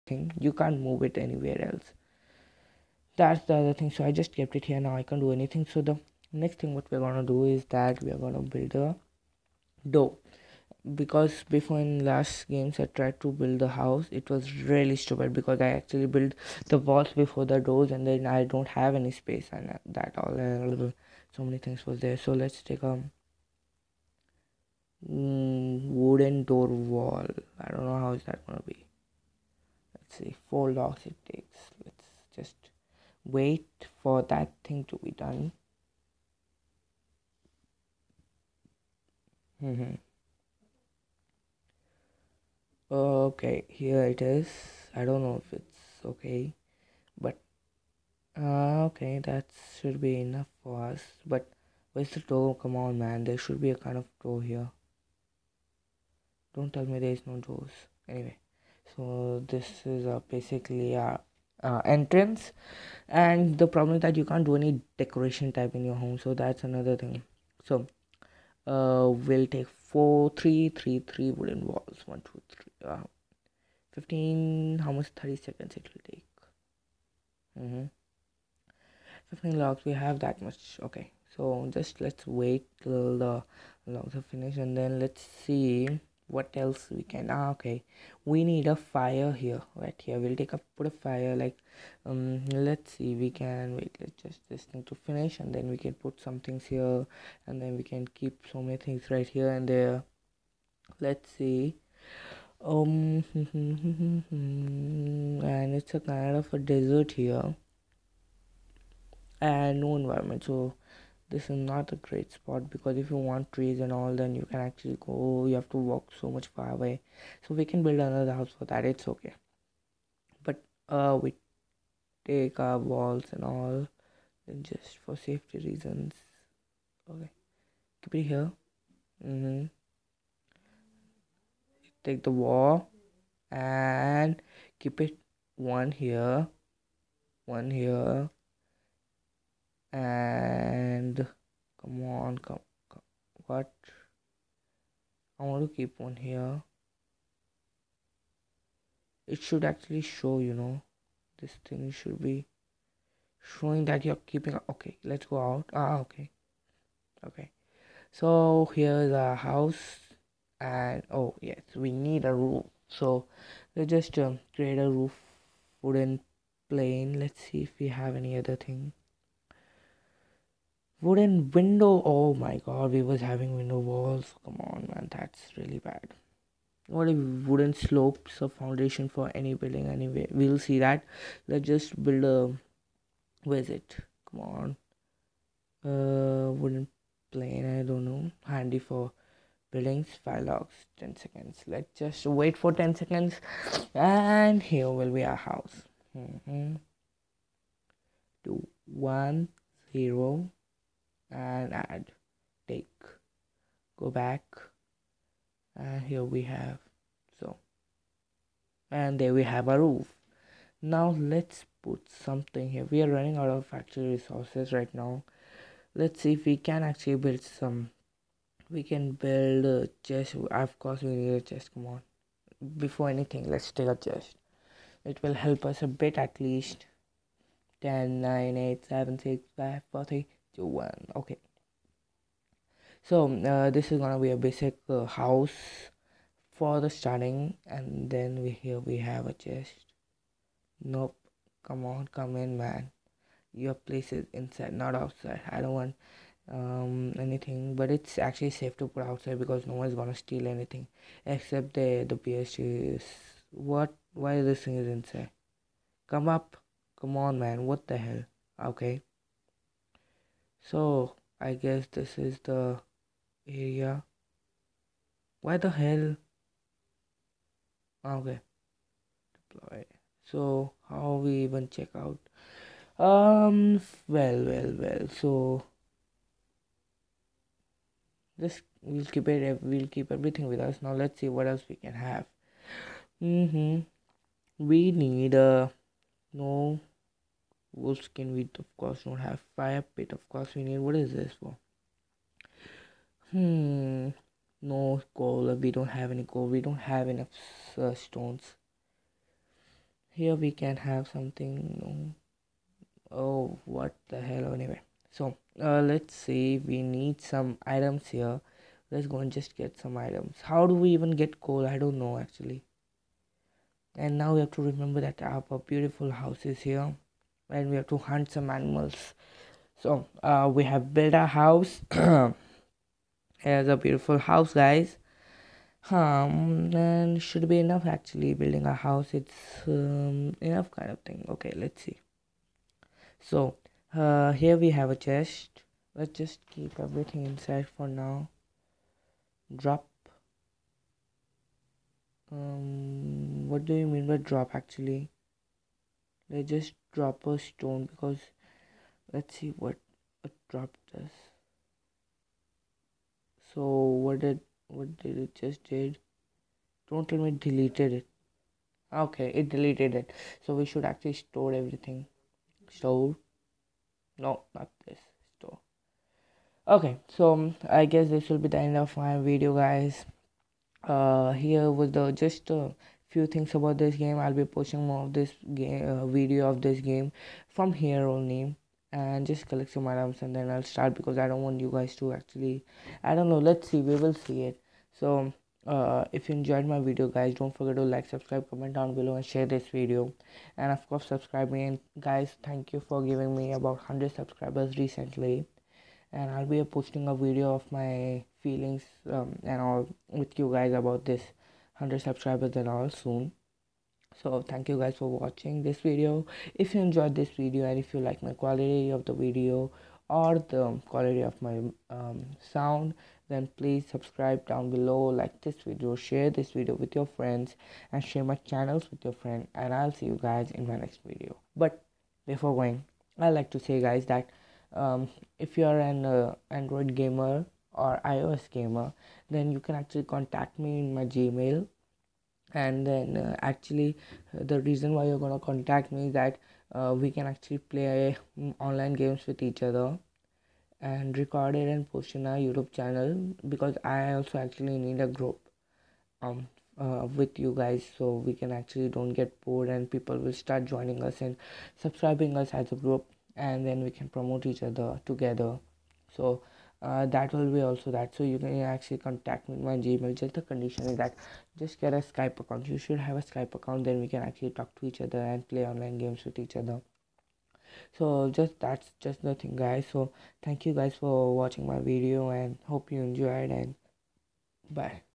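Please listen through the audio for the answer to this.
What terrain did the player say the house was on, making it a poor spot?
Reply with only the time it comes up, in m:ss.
1:46.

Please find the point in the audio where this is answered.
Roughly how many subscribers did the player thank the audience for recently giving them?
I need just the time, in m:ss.
6:33.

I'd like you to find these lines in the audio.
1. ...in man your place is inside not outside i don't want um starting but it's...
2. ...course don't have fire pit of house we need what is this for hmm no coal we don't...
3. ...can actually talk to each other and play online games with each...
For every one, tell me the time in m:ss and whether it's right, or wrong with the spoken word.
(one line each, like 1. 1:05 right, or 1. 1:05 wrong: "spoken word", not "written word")
1. 4:02 wrong: "anything", not "starting"
2. 4:48 wrong: "course", not "house"
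3. 7:44 right.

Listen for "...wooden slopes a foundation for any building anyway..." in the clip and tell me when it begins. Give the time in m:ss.
2:57.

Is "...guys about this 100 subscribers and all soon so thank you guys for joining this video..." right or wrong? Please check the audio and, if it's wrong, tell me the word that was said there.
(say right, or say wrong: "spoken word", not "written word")
wrong: "watching", not "joining".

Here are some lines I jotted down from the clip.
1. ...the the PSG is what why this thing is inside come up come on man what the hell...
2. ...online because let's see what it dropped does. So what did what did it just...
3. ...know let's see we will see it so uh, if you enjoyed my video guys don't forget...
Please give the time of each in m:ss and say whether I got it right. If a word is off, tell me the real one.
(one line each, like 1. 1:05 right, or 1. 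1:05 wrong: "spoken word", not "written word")
1. 4:11 right
2. 5:47 wrong: "stone", not "online"
3. 6:23 right.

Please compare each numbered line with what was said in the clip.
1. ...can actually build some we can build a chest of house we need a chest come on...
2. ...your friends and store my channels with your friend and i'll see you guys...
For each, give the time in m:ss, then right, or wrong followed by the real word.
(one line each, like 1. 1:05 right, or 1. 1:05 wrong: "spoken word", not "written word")
1. 3:36 wrong: "course", not "house"
2. 6:56 wrong: "share", not "store".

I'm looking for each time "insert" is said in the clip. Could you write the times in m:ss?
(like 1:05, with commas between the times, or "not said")
not said.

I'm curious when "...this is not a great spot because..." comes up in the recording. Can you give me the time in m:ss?
1:51.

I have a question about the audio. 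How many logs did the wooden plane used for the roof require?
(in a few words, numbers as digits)
5.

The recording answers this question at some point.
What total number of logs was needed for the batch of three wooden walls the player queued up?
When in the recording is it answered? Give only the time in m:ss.
1:19.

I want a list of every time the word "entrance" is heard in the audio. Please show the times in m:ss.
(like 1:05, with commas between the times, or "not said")
1:01.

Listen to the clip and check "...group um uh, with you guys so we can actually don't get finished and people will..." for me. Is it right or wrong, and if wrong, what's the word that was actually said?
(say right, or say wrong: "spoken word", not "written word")
wrong: "bored", not "finished".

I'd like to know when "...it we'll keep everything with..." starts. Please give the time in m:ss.
4:39.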